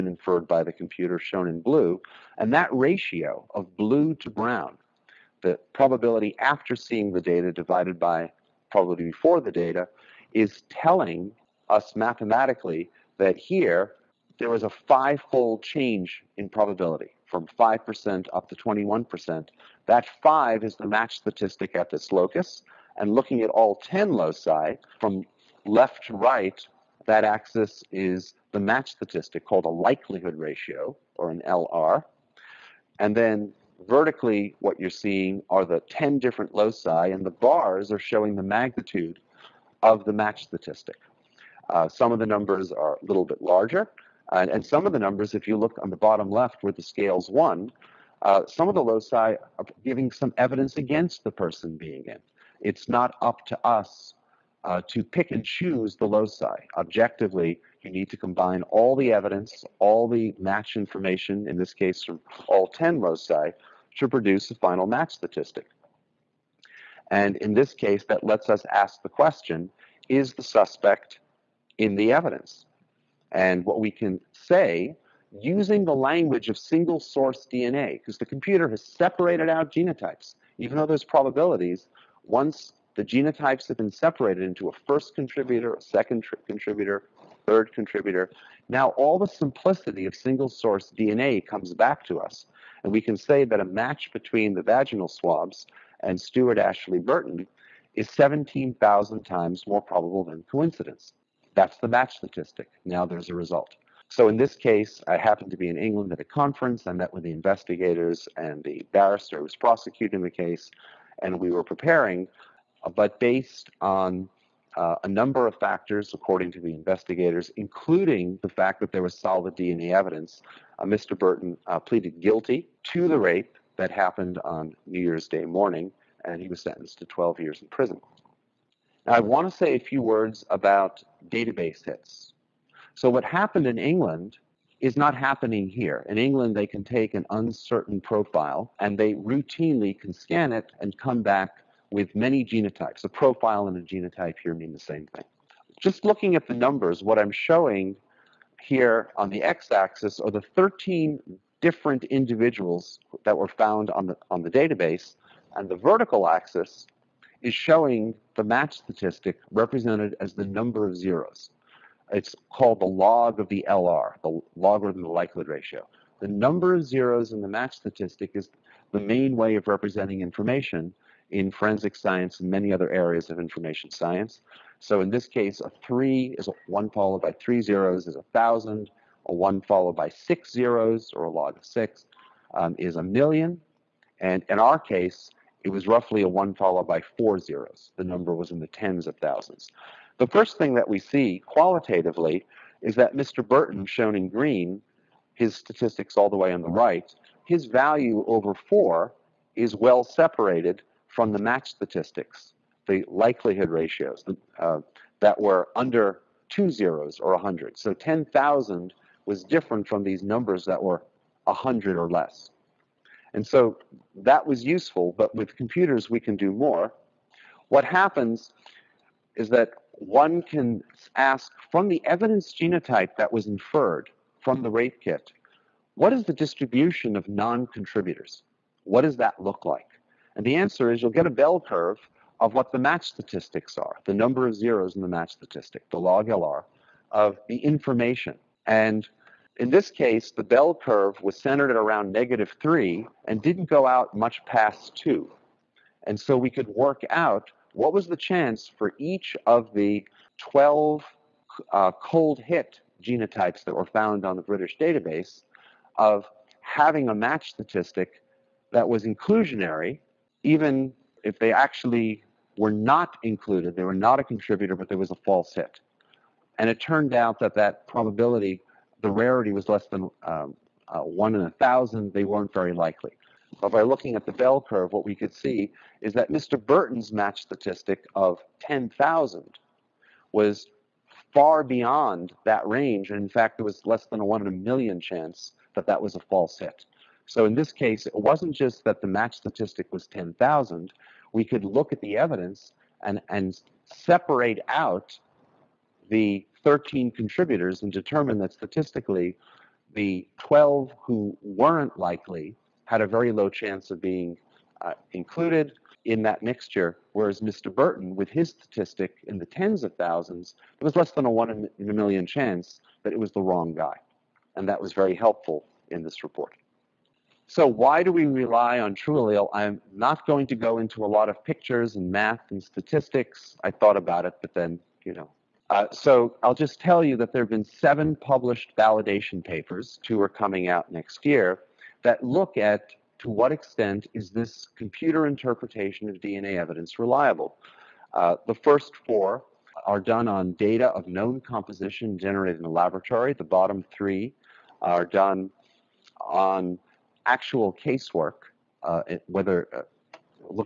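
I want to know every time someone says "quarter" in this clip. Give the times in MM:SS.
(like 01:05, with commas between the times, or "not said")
not said.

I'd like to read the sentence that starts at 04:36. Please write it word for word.
Burton's match statistic of 10,000 was far beyond that range.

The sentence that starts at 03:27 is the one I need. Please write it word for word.
So 10,000 was different from these numbers that were 100 or less.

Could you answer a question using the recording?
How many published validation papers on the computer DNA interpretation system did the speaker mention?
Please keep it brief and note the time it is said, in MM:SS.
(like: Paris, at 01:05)
7, at 05:27.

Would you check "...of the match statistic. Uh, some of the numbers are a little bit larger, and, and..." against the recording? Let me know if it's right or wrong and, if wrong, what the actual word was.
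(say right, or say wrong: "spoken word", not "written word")
right.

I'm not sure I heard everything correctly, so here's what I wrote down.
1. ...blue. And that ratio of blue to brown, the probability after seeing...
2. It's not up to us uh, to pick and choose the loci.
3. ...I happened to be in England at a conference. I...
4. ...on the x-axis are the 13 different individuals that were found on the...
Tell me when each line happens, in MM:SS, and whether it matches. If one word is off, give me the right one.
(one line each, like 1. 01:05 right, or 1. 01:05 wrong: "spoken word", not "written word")
1. 00:01 right
2. 00:52 right
3. 01:45 right
4. 02:29 right.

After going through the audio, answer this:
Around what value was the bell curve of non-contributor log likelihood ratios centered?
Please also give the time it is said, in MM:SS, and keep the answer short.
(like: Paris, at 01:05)
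-3, at 04:02.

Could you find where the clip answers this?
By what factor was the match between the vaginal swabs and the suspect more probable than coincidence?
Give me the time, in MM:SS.
01:38.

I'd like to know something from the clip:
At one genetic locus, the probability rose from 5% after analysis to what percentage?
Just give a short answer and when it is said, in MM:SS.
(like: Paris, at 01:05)
21%, at 00:18.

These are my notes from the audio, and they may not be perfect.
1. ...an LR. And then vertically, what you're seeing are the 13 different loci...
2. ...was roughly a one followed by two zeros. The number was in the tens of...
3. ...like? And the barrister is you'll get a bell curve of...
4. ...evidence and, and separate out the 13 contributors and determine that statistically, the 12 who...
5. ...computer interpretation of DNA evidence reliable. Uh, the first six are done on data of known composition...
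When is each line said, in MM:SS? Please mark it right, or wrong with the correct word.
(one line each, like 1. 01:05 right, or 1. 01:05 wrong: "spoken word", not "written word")
1. 00:31 wrong: "10", not "13"
2. 03:05 wrong: "four", not "two"
3. 03:49 wrong: "answer", not "barrister"
4. 04:52 right
5. 05:34 wrong: "four", not "six".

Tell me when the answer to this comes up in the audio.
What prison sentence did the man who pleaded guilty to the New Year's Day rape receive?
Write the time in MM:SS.
02:07.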